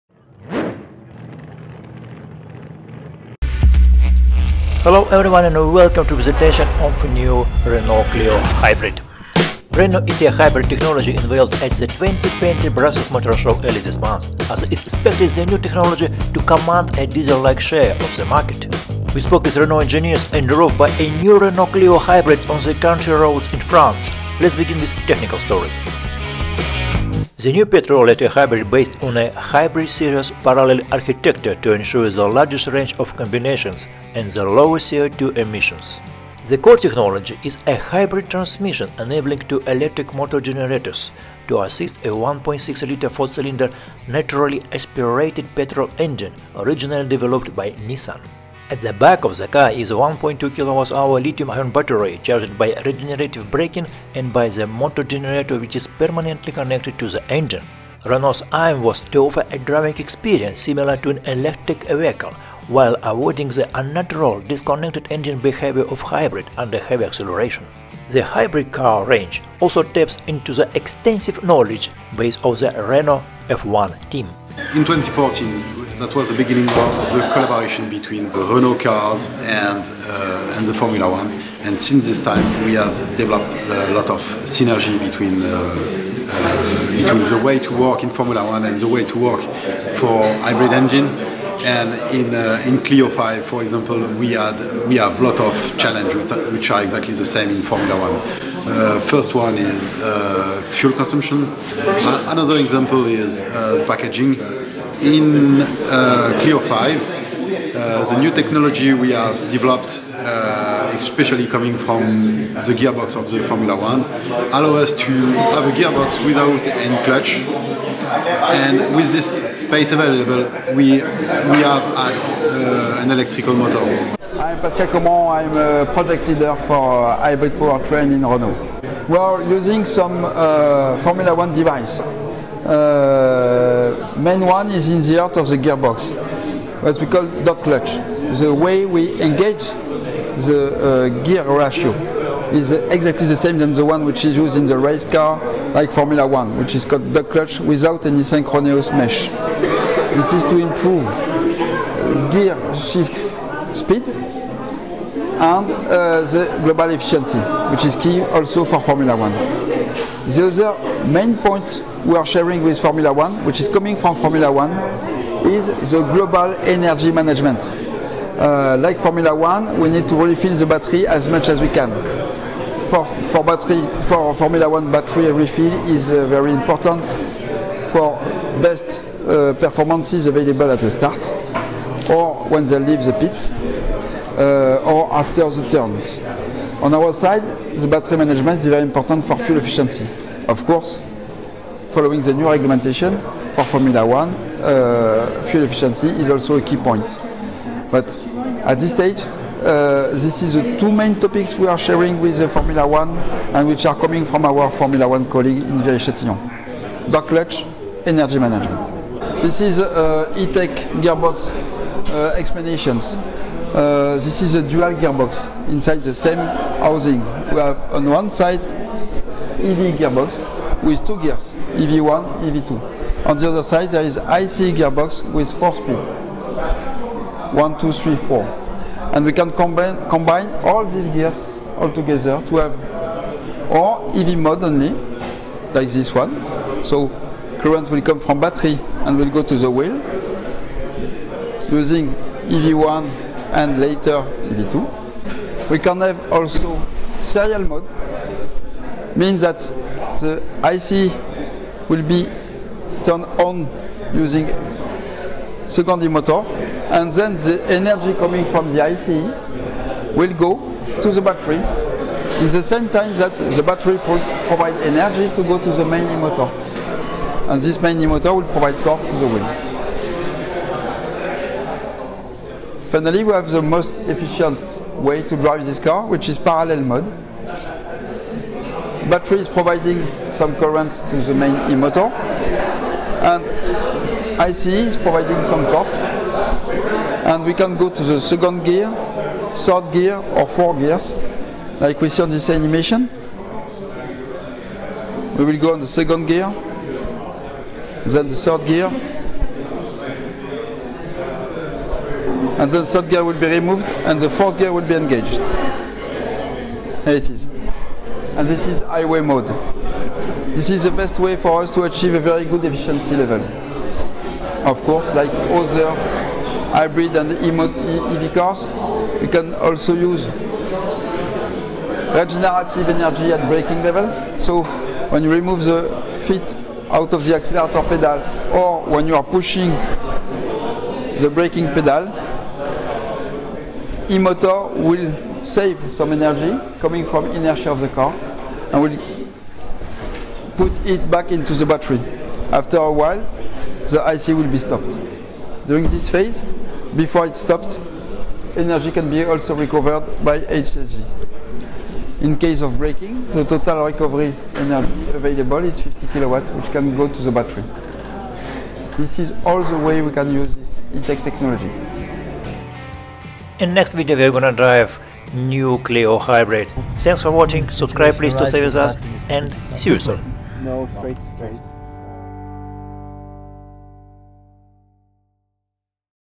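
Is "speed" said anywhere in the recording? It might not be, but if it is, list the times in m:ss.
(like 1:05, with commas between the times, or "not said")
2:33, 3:45.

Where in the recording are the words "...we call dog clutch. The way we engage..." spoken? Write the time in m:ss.
2:16.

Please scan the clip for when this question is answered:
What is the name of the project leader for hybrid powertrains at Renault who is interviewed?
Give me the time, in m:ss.
2:04.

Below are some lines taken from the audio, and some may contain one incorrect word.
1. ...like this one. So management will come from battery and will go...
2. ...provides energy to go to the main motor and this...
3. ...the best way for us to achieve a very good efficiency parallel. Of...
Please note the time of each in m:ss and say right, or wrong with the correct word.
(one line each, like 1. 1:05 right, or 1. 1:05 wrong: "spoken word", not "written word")
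1. 3:55 wrong: "current", not "management"
2. 4:24 right
3. 5:10 wrong: "level", not "parallel".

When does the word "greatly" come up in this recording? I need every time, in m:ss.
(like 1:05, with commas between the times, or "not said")
not said.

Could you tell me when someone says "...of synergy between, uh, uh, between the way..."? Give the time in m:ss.
1:24.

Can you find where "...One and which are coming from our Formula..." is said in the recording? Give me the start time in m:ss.
3:22.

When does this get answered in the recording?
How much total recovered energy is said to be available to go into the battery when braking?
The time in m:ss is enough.
5:55.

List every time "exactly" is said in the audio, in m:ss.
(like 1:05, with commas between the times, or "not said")
1:36, 2:22.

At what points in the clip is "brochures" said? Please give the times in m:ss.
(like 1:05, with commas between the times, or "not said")
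not said.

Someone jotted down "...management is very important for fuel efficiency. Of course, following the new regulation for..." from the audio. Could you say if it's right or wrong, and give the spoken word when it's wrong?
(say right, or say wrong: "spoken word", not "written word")
right.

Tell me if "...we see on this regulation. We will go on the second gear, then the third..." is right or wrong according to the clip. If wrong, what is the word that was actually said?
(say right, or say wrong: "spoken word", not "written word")
wrong: "animation", not "regulation".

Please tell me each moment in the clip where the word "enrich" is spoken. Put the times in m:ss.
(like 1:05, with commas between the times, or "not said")
not said.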